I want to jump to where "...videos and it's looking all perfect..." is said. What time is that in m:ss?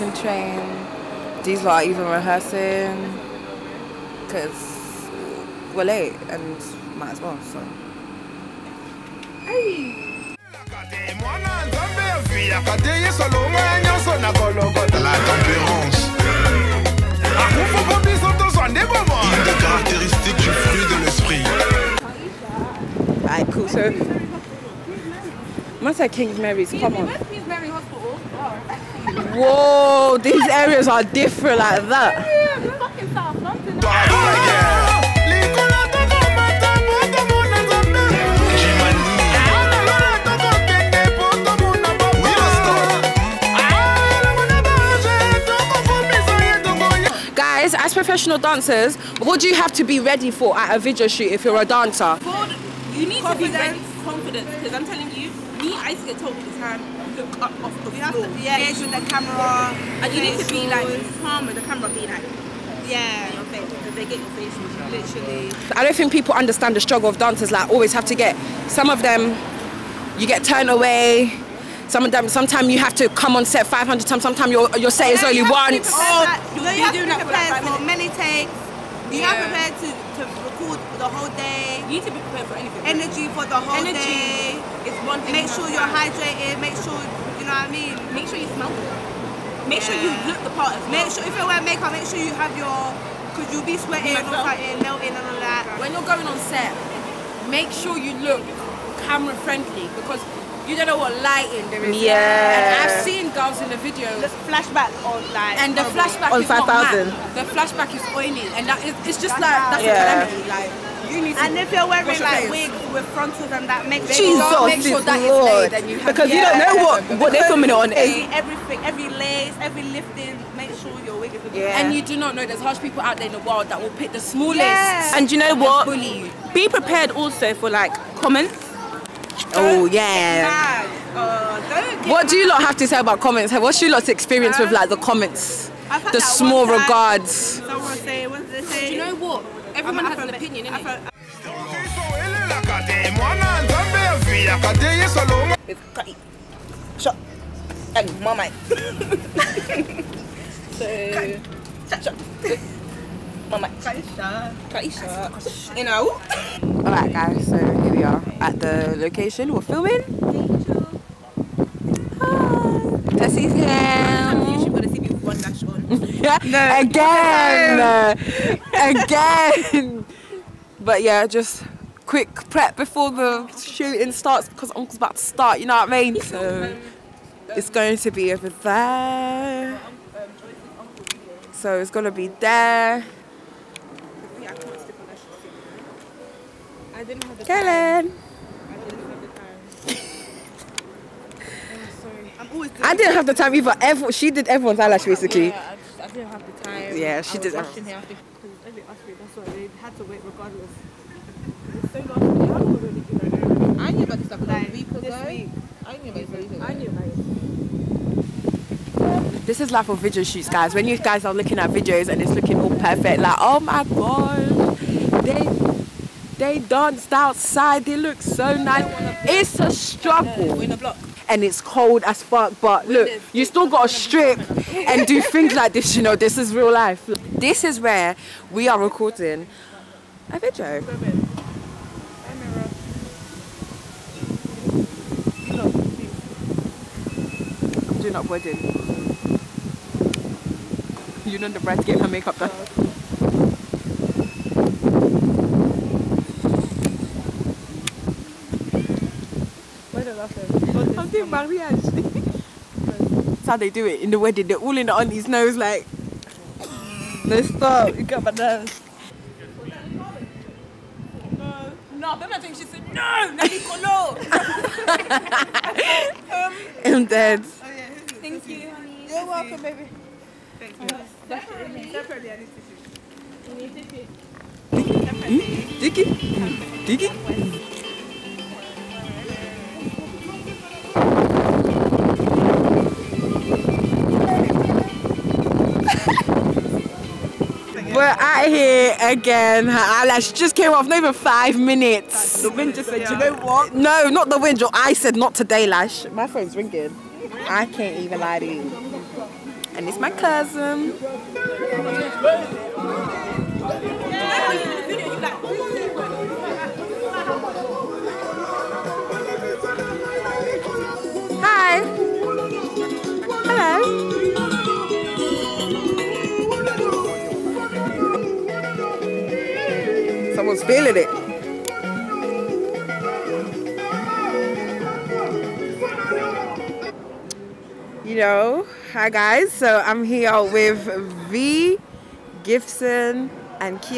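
3:31.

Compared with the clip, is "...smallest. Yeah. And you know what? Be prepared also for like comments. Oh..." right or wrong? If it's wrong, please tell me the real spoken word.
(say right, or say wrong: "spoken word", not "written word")
right.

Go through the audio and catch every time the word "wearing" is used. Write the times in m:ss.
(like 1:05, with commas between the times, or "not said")
1:31, 1:51.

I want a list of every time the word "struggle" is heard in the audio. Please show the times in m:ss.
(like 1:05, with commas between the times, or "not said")
1:06, 3:39.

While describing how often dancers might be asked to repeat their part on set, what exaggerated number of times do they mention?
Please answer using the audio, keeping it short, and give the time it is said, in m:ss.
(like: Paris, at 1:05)
500, at 1:13.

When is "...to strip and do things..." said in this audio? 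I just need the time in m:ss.
3:43.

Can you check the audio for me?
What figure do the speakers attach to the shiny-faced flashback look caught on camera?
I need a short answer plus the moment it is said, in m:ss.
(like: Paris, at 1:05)
5,000, at 1:46.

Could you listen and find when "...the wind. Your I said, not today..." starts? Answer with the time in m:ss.
4:54.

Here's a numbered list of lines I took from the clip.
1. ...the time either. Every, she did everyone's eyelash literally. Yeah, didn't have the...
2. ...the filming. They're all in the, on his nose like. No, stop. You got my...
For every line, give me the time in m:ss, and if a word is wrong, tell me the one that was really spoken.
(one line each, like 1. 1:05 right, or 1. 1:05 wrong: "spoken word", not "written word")
1. 3:13 wrong: "basically", not "literally"
2. 4:14 wrong: "wedding", not "filming".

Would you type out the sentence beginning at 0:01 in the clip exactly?
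These lot are even rehearsing because we're late and might as well.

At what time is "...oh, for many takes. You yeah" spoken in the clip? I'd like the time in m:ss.
1:17.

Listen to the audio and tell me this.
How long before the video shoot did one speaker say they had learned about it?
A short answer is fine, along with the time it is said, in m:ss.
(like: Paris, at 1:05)
a week ago, at 3:24.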